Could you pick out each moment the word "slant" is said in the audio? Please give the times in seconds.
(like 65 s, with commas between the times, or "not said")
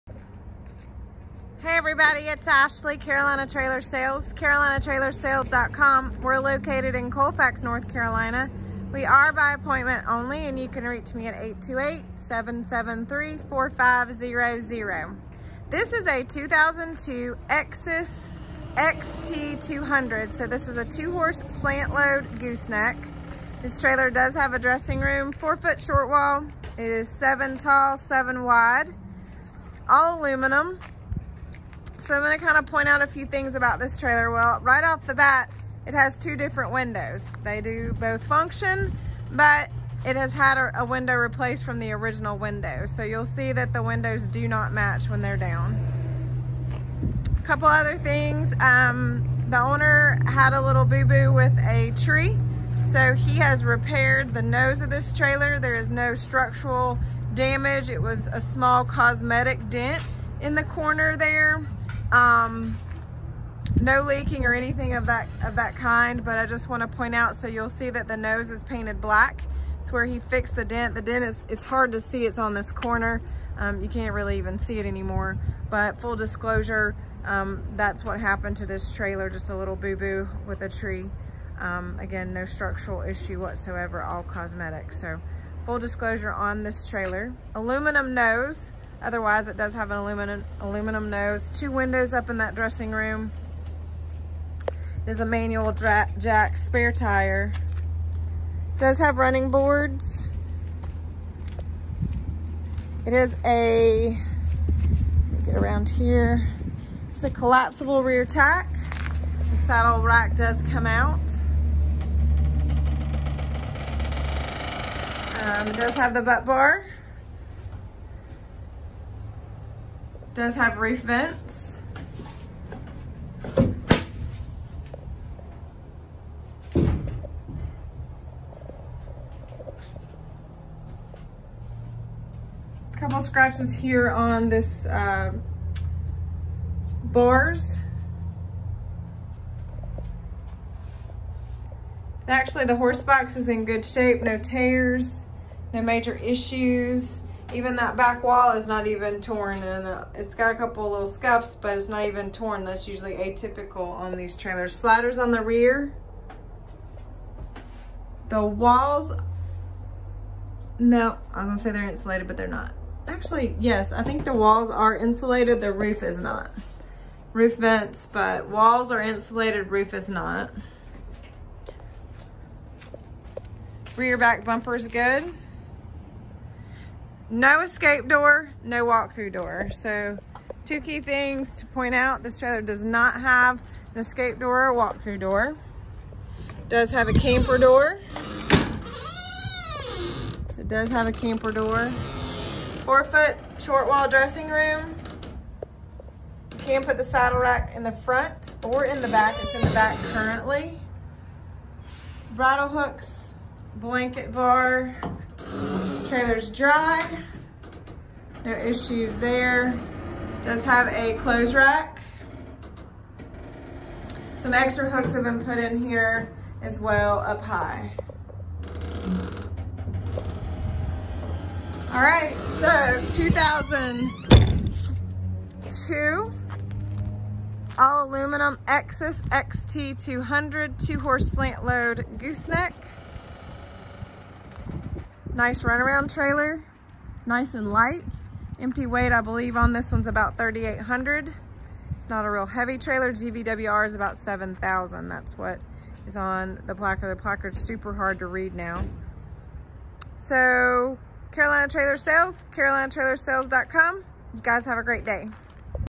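21 s, 231 s.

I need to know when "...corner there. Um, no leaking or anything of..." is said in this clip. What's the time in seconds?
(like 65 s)
60 s.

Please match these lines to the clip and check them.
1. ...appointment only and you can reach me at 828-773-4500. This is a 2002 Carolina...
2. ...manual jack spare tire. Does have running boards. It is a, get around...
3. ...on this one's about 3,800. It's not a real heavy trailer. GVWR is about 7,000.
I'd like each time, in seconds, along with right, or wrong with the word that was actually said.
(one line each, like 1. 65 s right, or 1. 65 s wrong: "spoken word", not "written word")
1. 9 s wrong: "Exiss", not "Carolina"
2. 95 s right
3. 239 s right.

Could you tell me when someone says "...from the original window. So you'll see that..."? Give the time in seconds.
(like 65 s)
41 s.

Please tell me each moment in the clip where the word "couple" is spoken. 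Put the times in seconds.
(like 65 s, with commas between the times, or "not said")
47 s, 132 s, 150 s.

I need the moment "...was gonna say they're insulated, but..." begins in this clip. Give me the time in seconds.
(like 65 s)
161 s.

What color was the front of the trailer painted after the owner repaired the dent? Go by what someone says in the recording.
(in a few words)
black.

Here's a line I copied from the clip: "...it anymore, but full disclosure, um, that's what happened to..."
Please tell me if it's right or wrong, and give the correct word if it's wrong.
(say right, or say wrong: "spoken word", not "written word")
right.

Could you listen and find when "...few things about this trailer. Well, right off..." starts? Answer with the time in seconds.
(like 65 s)
33 s.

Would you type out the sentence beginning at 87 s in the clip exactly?
Aluminum nose, Otherwise, it does have an aluminum, aluminum nose.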